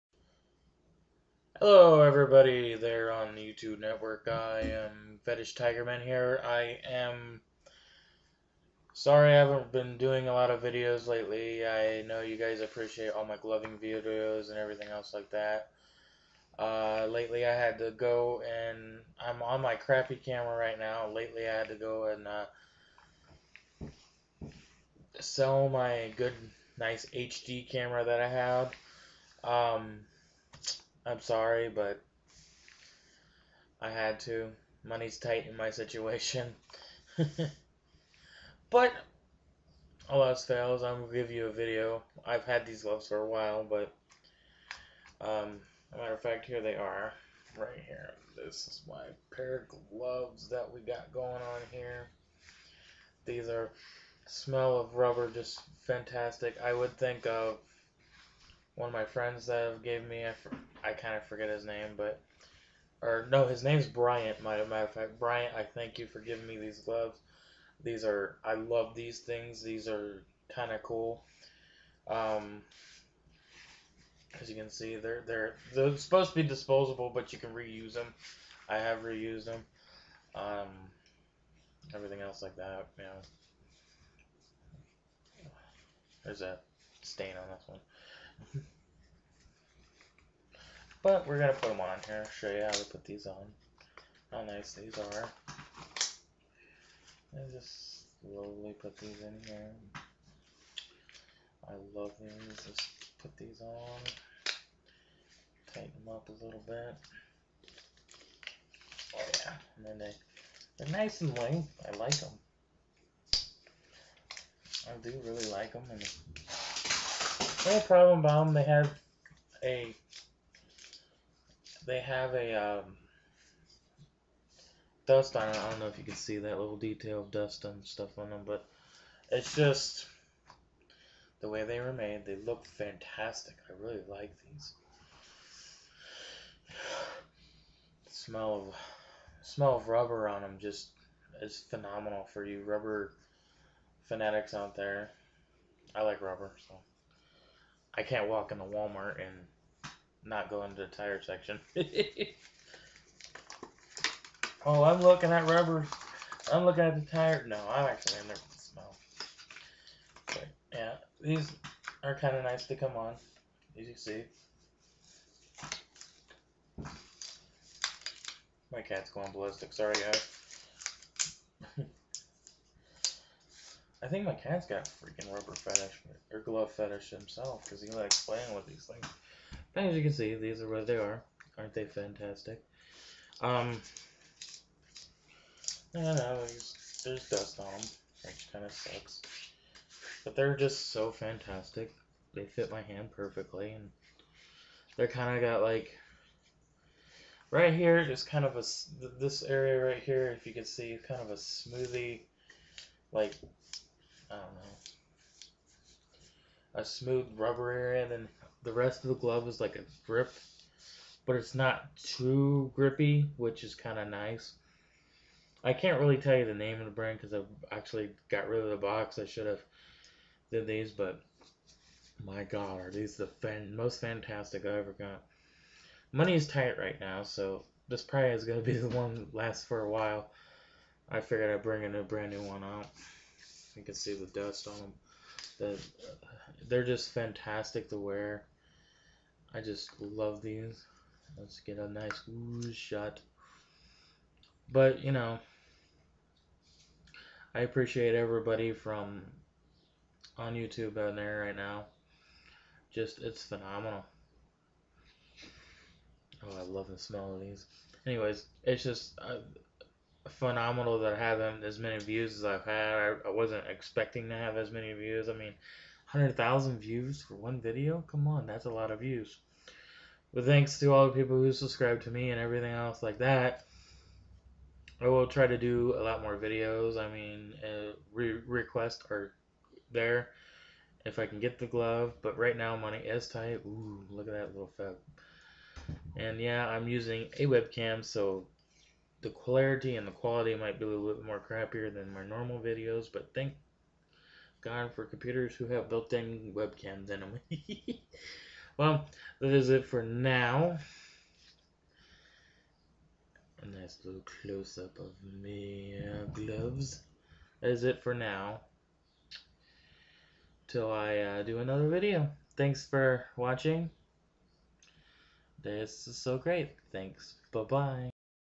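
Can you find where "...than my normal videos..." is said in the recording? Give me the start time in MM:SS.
04:51.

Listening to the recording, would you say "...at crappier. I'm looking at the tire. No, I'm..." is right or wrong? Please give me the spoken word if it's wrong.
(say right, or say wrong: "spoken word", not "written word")
wrong: "rubber", not "crappier".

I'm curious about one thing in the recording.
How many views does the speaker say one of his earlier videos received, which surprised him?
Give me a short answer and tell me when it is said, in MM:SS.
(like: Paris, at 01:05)
100,000, at 04:26.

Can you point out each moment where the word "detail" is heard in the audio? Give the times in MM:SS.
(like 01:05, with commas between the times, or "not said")
02:06.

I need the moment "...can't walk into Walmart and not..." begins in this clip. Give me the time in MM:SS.
02:28.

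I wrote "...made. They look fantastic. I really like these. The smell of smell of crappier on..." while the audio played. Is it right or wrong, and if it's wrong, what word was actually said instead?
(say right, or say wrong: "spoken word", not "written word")
wrong: "rubber", not "crappier".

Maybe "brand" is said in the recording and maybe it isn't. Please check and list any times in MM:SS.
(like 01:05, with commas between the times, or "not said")
03:36, 03:52.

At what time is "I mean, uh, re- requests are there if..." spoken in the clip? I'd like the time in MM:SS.
04:36.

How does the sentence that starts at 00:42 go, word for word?
I've had these gloves for a while, but, um, matter of fact, here they are.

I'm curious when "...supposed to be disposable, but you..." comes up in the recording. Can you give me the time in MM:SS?
01:15.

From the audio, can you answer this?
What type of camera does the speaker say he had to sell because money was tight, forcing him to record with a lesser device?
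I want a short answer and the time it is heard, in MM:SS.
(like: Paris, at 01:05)
HD camera, at 00:27.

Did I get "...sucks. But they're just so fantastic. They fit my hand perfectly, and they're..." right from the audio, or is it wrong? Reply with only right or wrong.
right.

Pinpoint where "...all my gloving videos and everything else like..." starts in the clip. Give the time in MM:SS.
00:13.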